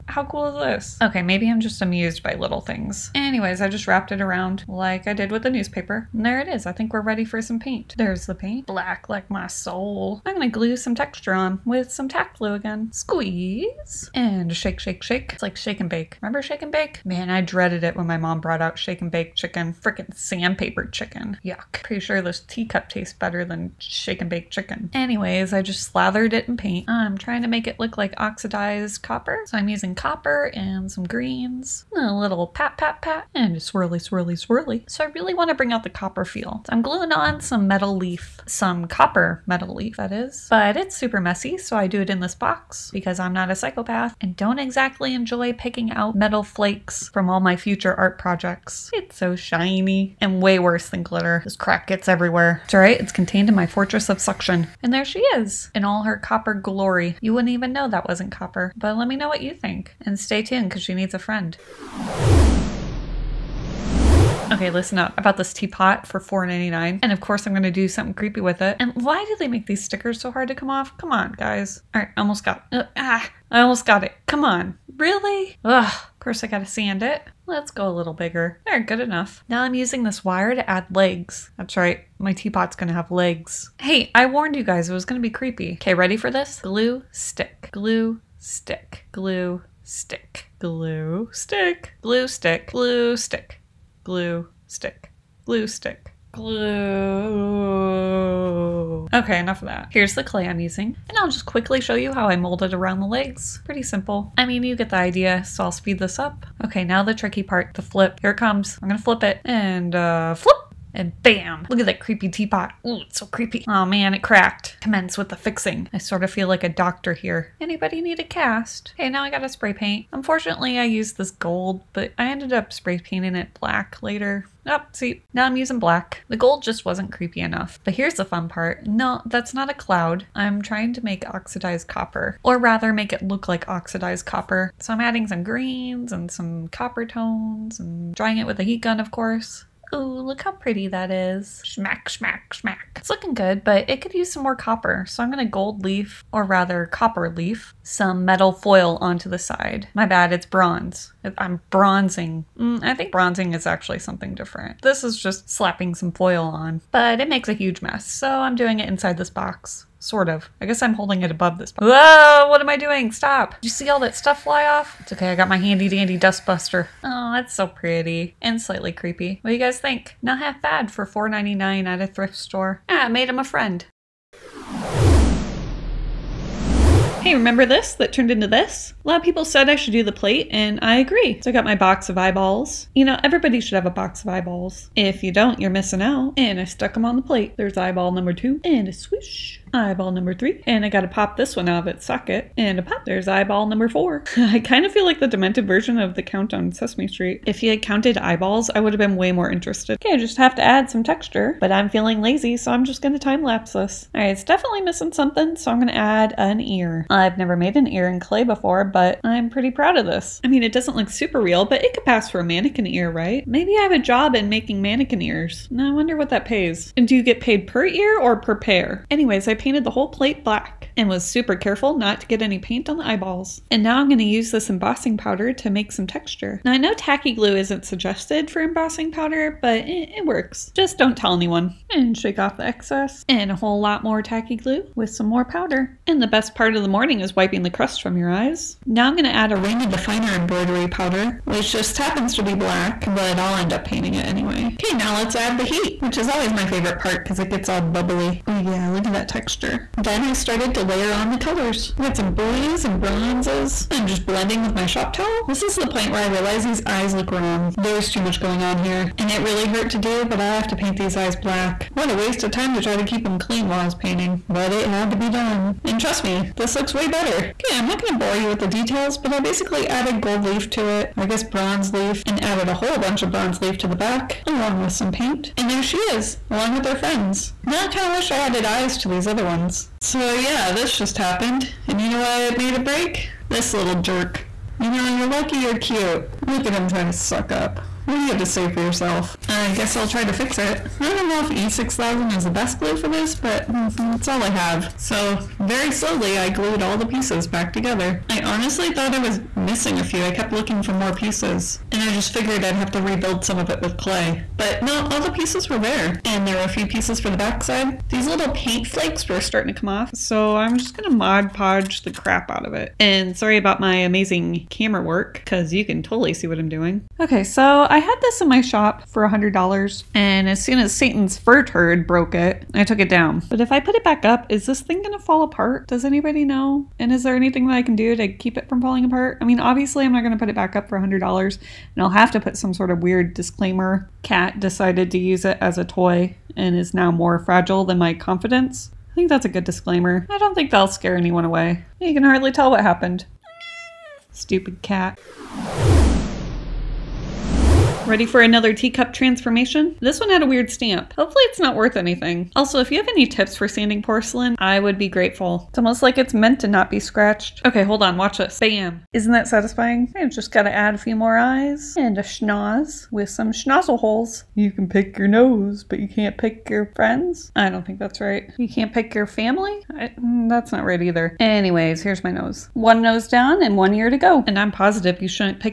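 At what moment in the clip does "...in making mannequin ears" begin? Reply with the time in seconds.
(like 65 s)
214 s.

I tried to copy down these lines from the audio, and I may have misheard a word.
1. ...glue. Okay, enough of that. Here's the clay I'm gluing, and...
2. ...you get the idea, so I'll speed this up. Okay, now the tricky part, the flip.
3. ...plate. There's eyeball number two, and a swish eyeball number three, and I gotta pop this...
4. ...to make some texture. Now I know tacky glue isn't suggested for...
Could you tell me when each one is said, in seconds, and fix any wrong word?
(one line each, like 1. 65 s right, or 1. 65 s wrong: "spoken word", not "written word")
1. 96 s wrong: "using", not "gluing"
2. 104 s right
3. 187 s right
4. 225 s right.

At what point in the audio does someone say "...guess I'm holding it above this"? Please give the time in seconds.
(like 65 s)
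160 s.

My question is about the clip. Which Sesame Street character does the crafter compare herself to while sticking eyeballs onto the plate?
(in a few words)
the Count.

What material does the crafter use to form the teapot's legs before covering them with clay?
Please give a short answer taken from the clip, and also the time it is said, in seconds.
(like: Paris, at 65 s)
wire, at 80 s.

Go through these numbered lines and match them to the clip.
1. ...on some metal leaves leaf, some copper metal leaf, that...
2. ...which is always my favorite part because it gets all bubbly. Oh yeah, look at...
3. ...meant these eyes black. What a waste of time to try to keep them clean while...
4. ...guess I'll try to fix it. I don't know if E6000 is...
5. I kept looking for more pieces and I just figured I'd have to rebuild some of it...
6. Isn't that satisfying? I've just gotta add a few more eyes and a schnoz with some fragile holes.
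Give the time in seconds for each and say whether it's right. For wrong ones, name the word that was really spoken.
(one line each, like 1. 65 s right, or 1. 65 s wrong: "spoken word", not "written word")
1. 37 s right
2. 246 s right
3. 260 s wrong: "paint", not "meant"
4. 289 s right
5. 300 s right
6. 359 s wrong: "schnozzle", not "fragile".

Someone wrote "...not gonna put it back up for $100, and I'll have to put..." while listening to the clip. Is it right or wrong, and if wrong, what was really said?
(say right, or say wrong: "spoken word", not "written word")
right.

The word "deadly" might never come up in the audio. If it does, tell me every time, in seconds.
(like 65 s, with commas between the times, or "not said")
not said.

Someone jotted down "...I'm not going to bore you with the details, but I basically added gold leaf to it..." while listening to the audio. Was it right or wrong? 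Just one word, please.
right.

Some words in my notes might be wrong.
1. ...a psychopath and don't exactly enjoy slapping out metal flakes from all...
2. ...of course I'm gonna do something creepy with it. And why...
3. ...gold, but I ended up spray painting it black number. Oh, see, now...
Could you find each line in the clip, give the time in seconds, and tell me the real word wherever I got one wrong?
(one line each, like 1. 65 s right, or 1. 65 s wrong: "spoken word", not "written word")
1. 43 s wrong: "picking", not "slapping"
2. 67 s right
3. 121 s wrong: "later", not "number".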